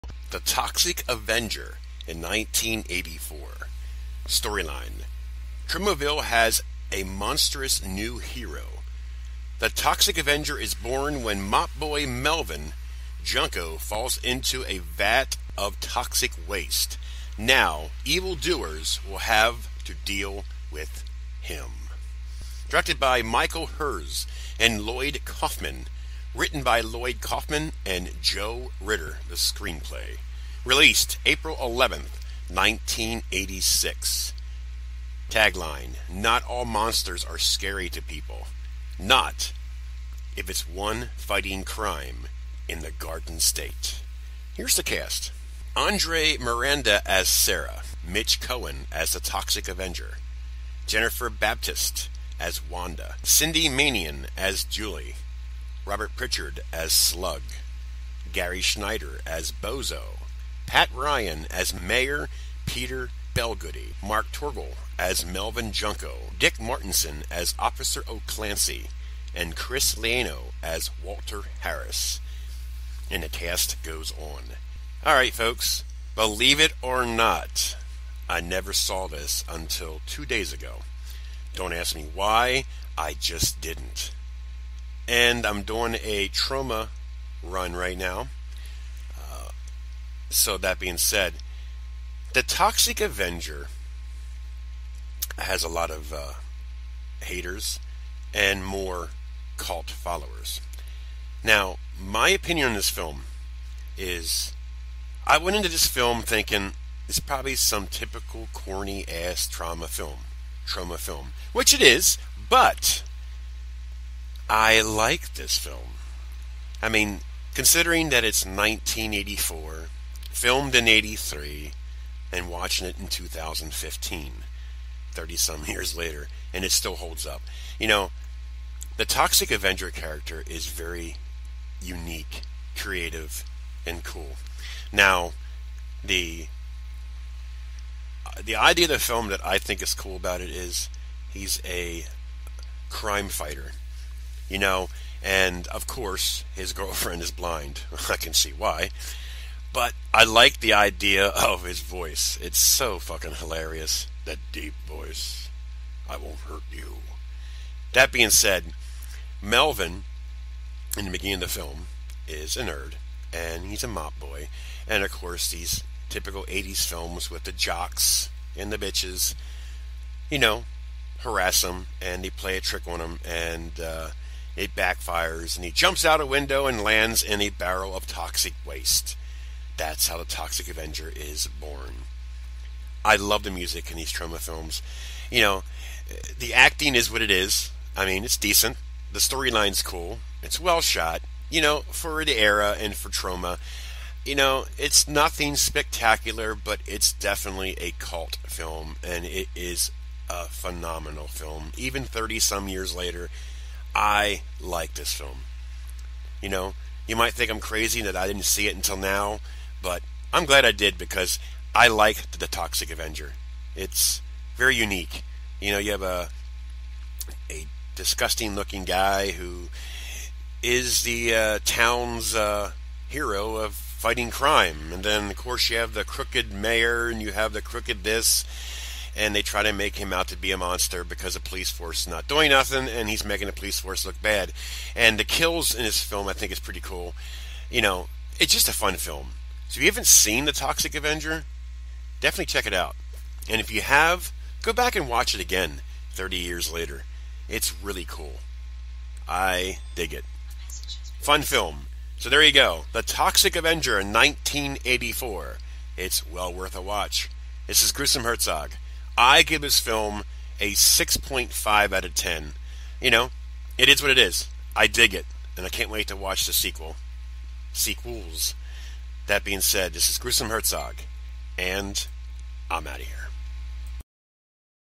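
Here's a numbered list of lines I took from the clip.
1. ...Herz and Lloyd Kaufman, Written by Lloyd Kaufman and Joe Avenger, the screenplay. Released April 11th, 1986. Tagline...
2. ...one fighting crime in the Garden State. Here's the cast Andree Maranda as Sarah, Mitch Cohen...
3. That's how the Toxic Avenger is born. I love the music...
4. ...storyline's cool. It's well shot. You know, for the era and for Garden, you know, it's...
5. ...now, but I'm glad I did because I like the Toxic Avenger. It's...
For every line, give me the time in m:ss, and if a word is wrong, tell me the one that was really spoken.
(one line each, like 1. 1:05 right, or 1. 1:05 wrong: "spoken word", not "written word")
1. 0:23 wrong: "Ritter", not "Avenger"
2. 0:40 right
3. 2:59 right
4. 3:09 wrong: "Troma", not "Garden"
5. 3:28 right.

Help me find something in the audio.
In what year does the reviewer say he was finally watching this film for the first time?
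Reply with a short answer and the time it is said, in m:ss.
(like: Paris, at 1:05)
2015, at 2:03.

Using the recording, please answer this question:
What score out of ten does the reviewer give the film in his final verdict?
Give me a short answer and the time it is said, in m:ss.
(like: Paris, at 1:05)
6.5, at 4:20.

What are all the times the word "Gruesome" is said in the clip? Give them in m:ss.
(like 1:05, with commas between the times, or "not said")
4:17, 4:30.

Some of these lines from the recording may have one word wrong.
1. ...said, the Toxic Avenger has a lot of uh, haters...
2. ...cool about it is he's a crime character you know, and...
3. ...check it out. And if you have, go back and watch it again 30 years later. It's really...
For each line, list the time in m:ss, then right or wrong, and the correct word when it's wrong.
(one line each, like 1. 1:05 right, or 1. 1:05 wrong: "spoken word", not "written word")
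1. 1:30 right
2. 2:19 wrong: "fighter", not "character"
3. 4:02 right.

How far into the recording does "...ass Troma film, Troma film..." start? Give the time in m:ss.
1:49.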